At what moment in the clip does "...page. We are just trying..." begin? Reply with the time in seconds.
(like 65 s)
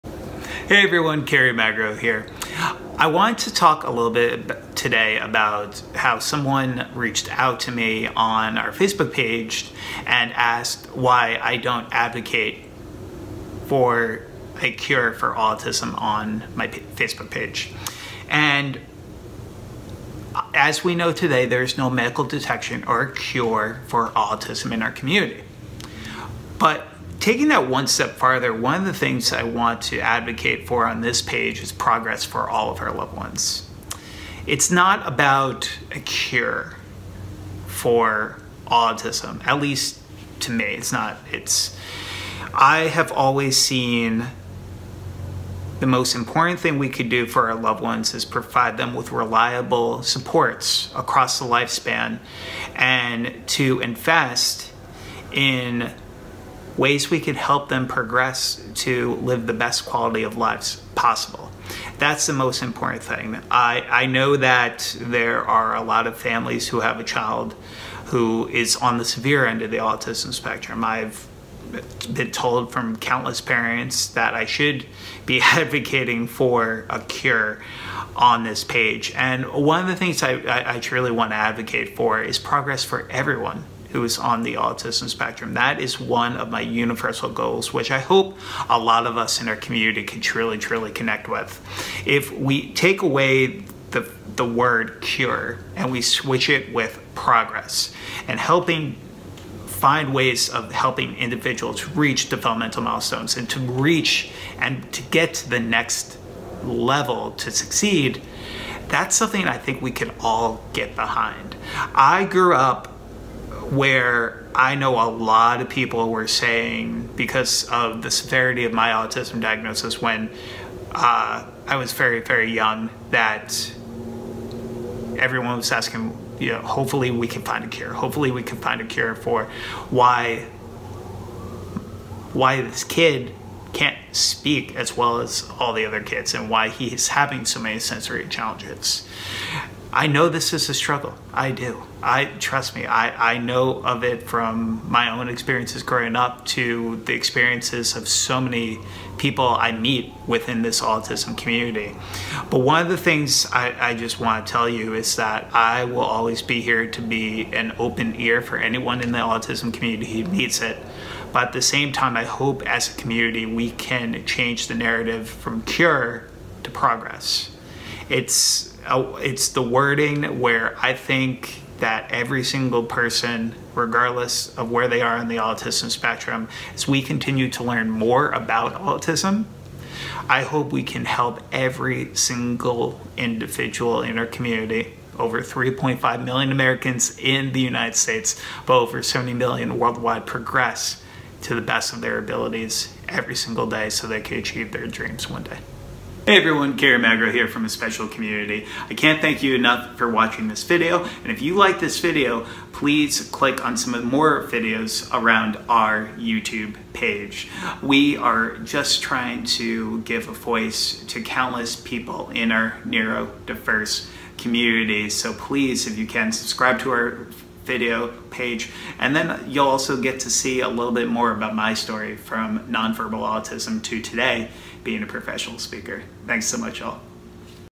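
206 s.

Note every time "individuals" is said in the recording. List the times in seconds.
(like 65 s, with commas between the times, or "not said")
101 s, 183 s.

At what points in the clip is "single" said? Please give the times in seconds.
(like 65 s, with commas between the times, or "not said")
172 s, 182 s, 193 s.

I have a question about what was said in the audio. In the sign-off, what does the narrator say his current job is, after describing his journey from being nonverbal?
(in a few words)
Professional speaker.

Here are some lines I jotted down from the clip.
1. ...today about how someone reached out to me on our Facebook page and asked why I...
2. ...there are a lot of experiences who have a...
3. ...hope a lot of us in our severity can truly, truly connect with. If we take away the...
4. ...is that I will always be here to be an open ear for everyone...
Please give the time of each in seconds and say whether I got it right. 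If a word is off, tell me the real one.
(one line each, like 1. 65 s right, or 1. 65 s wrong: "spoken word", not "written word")
1. 4 s right
2. 64 s wrong: "families", not "experiences"
3. 87 s wrong: "community", not "severity"
4. 154 s wrong: "anyone", not "everyone".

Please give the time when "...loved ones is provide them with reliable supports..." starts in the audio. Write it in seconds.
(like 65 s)
47 s.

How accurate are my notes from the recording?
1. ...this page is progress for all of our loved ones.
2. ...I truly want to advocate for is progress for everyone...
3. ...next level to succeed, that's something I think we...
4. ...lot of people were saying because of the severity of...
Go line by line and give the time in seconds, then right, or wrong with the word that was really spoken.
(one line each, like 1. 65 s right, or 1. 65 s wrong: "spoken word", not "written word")
1. 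31 s right
2. 80 s right
3. 105 s right
4. 115 s right.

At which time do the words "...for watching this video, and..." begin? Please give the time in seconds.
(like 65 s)
199 s.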